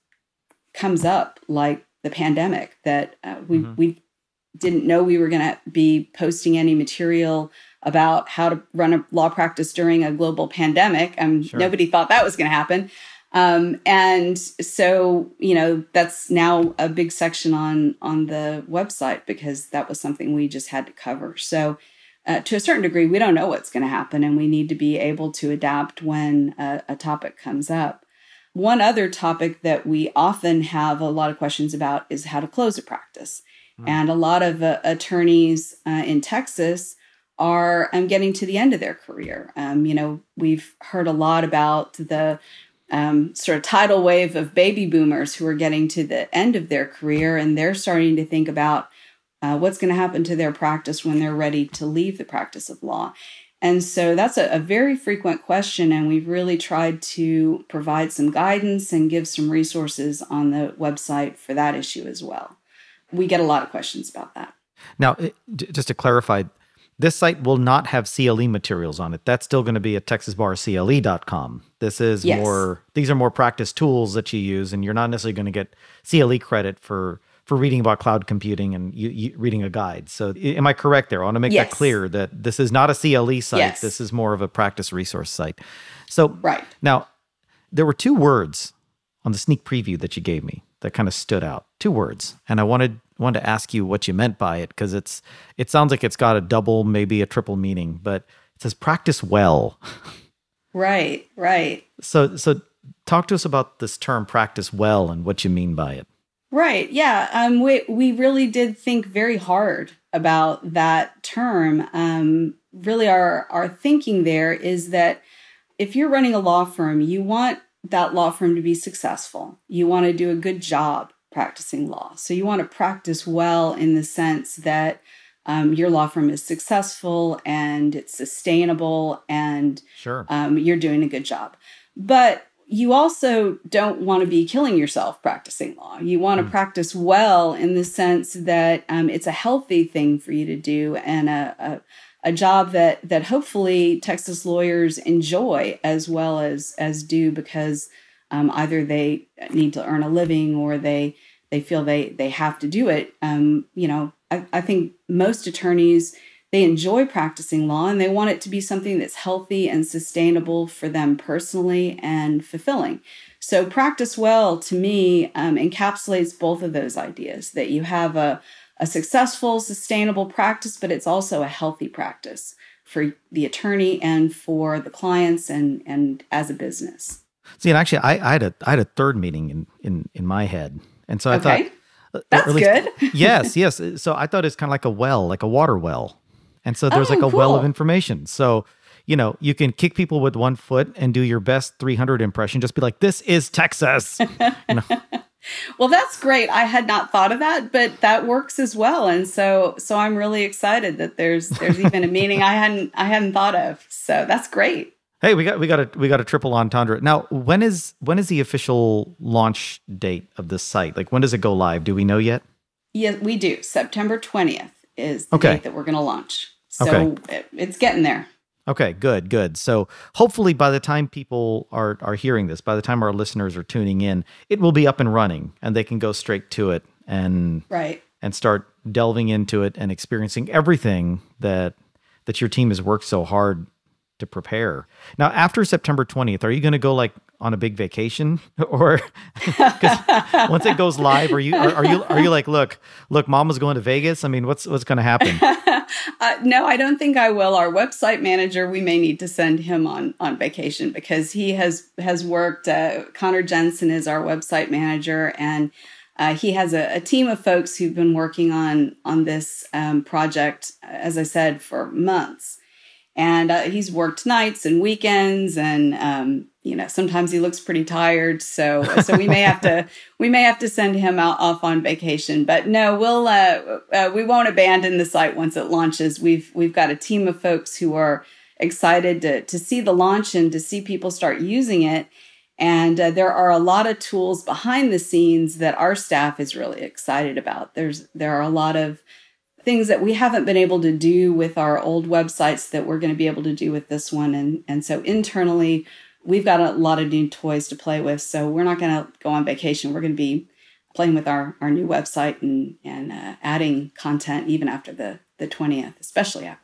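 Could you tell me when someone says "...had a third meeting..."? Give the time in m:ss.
2:58.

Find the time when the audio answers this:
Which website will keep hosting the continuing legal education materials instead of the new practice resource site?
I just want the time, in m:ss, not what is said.
1:10.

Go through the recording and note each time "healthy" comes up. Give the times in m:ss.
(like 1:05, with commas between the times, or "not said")
2:19, 2:39, 2:51.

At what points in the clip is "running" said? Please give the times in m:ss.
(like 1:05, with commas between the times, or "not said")
1:56, 3:45.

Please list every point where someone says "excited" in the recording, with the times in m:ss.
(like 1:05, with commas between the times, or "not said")
3:20, 4:38, 4:46.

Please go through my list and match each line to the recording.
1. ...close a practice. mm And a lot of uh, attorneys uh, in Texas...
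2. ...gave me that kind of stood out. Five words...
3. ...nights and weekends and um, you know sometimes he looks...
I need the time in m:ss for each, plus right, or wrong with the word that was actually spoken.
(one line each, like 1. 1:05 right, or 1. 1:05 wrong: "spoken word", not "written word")
1. 0:32 right
2. 1:30 wrong: "Two", not "Five"
3. 4:24 right.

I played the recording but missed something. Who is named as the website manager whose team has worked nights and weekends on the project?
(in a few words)
Connor Jensen.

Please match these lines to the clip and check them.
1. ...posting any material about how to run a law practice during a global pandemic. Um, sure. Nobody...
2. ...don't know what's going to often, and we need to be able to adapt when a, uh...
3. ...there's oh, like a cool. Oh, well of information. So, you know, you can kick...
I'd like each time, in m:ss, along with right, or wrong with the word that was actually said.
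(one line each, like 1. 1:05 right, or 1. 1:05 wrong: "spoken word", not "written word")
1. 0:06 right
2. 0:23 wrong: "happen", not "often"
3. 3:06 right.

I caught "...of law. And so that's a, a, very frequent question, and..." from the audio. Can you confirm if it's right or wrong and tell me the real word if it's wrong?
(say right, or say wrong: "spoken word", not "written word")
right.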